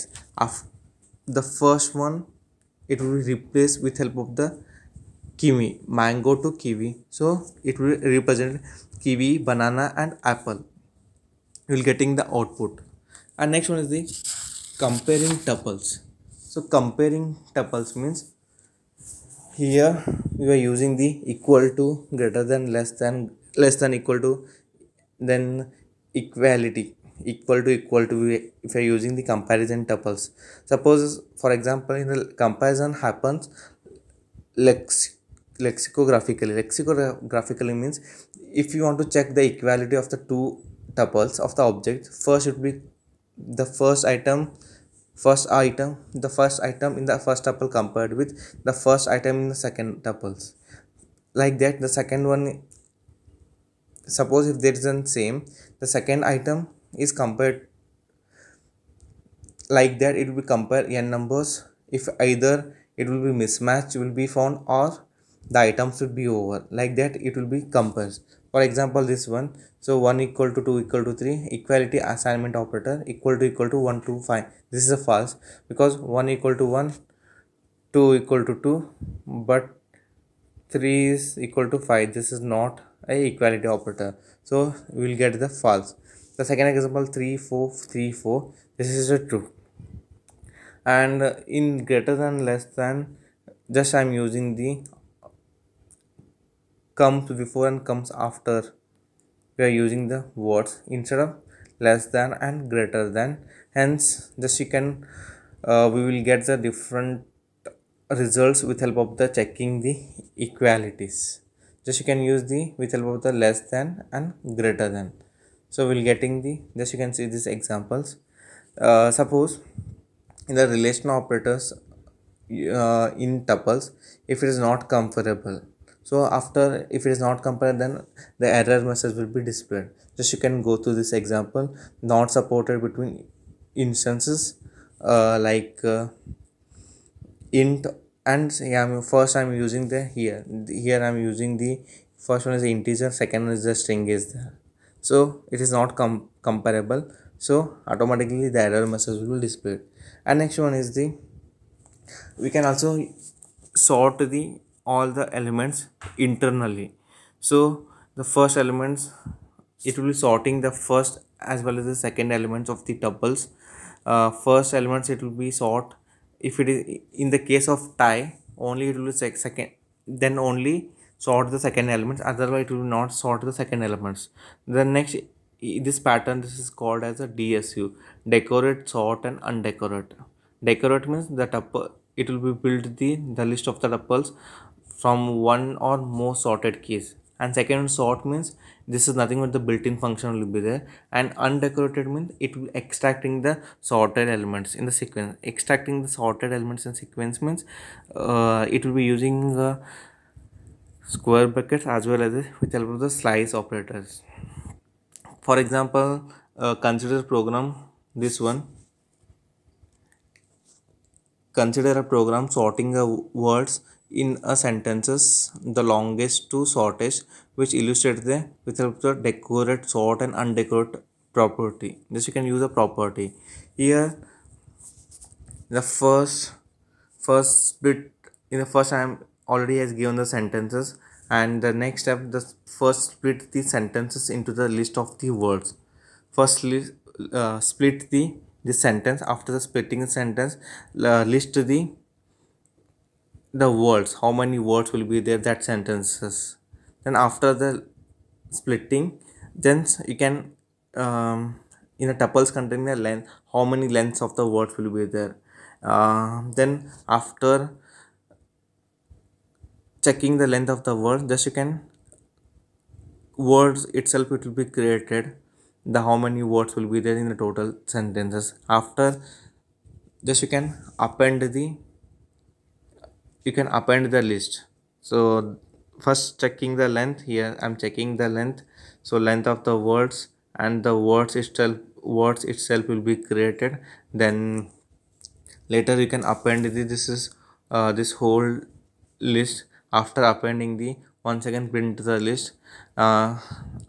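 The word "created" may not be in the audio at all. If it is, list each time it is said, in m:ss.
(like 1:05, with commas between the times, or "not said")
4:24, 4:43.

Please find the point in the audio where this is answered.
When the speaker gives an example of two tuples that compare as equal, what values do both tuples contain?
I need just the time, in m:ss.
1:27.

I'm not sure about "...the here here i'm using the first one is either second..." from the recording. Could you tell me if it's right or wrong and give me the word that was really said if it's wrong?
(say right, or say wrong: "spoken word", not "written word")
wrong: "integer", not "either".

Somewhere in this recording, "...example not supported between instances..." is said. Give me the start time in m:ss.
2:11.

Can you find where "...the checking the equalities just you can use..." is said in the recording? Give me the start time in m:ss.
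1:49.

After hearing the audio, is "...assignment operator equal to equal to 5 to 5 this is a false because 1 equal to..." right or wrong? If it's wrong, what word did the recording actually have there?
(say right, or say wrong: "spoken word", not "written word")
wrong: "1", not "5".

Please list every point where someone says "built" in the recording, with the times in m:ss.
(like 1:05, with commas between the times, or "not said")
3:02, 3:09.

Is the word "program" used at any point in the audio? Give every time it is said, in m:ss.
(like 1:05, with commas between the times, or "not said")
3:27, 3:32.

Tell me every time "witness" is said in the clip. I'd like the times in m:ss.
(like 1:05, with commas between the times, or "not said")
not said.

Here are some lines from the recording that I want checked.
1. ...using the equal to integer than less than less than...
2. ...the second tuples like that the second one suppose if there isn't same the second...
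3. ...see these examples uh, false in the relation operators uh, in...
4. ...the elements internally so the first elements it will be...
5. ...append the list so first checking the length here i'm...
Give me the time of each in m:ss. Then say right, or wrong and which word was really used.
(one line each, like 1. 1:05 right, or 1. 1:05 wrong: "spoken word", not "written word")
1. 0:20 wrong: "greater", not "integer"
2. 0:49 right
3. 1:57 wrong: "suppose", not "false"
4. 2:35 right
5. 4:33 right.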